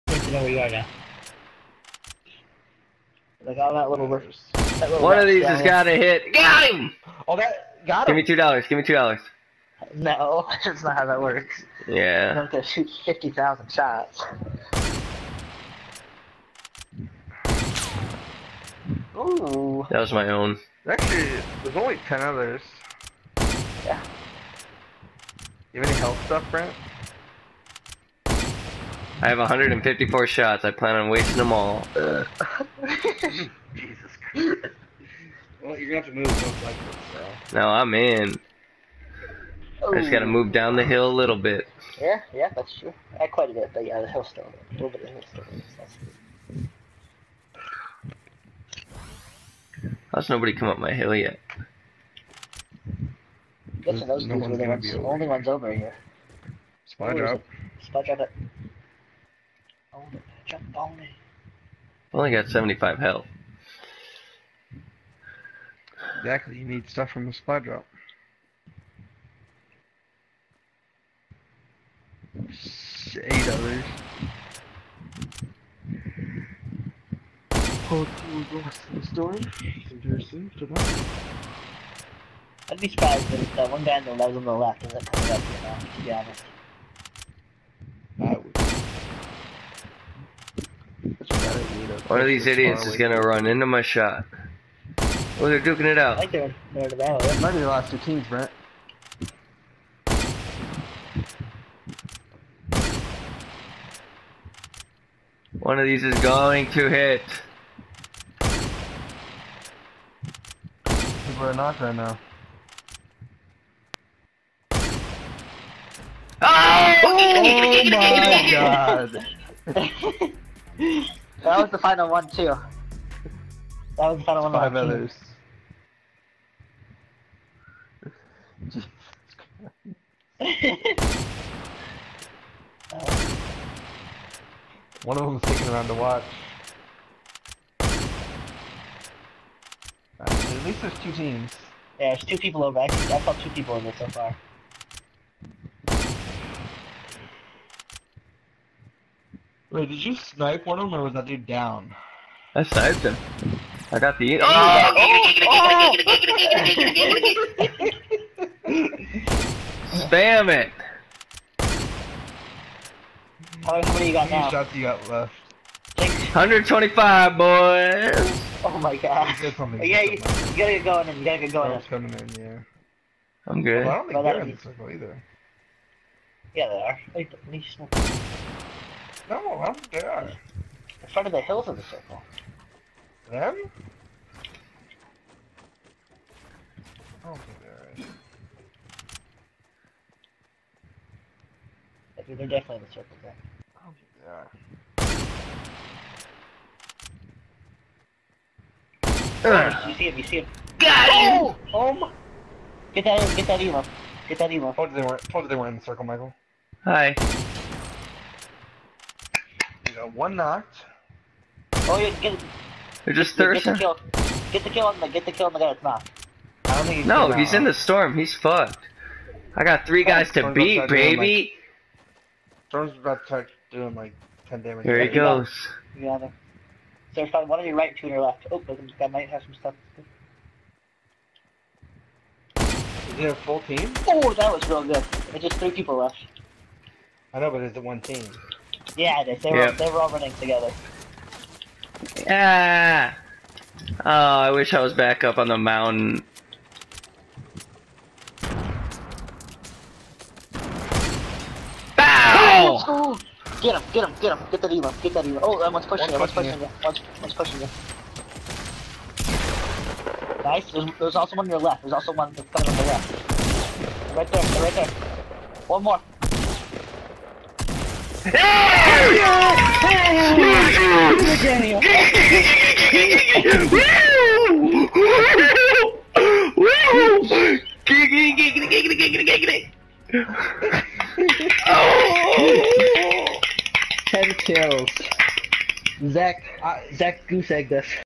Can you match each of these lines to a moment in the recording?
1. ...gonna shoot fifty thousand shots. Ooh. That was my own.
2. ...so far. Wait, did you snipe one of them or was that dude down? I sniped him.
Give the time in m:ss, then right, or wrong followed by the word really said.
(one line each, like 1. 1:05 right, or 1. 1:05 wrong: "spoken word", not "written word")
1. 0:12 right
2. 2:23 right.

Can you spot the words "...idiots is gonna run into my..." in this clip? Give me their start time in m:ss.
1:32.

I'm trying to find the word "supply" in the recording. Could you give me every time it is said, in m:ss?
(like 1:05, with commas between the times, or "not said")
1:07.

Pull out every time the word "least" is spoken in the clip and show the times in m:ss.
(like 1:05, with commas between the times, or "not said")
2:20, 2:57.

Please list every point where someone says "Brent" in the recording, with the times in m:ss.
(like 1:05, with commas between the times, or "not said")
0:26, 1:38.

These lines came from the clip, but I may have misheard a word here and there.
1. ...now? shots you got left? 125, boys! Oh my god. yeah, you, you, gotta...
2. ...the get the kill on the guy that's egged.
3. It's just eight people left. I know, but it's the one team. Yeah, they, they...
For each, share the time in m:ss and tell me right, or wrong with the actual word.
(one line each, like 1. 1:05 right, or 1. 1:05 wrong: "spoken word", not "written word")
1. 2:44 right
2. 3:34 wrong: "knocked", not "egged"
3. 3:55 wrong: "three", not "eight".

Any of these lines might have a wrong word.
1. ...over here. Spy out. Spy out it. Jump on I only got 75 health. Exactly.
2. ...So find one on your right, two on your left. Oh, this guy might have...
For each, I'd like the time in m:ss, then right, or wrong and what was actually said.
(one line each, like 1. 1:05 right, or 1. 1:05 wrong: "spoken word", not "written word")
1. 0:55 right
2. 3:47 right.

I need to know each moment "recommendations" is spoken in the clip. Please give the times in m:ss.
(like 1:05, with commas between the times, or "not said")
not said.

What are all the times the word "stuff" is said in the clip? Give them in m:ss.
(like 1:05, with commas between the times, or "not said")
0:26, 1:06, 3:49.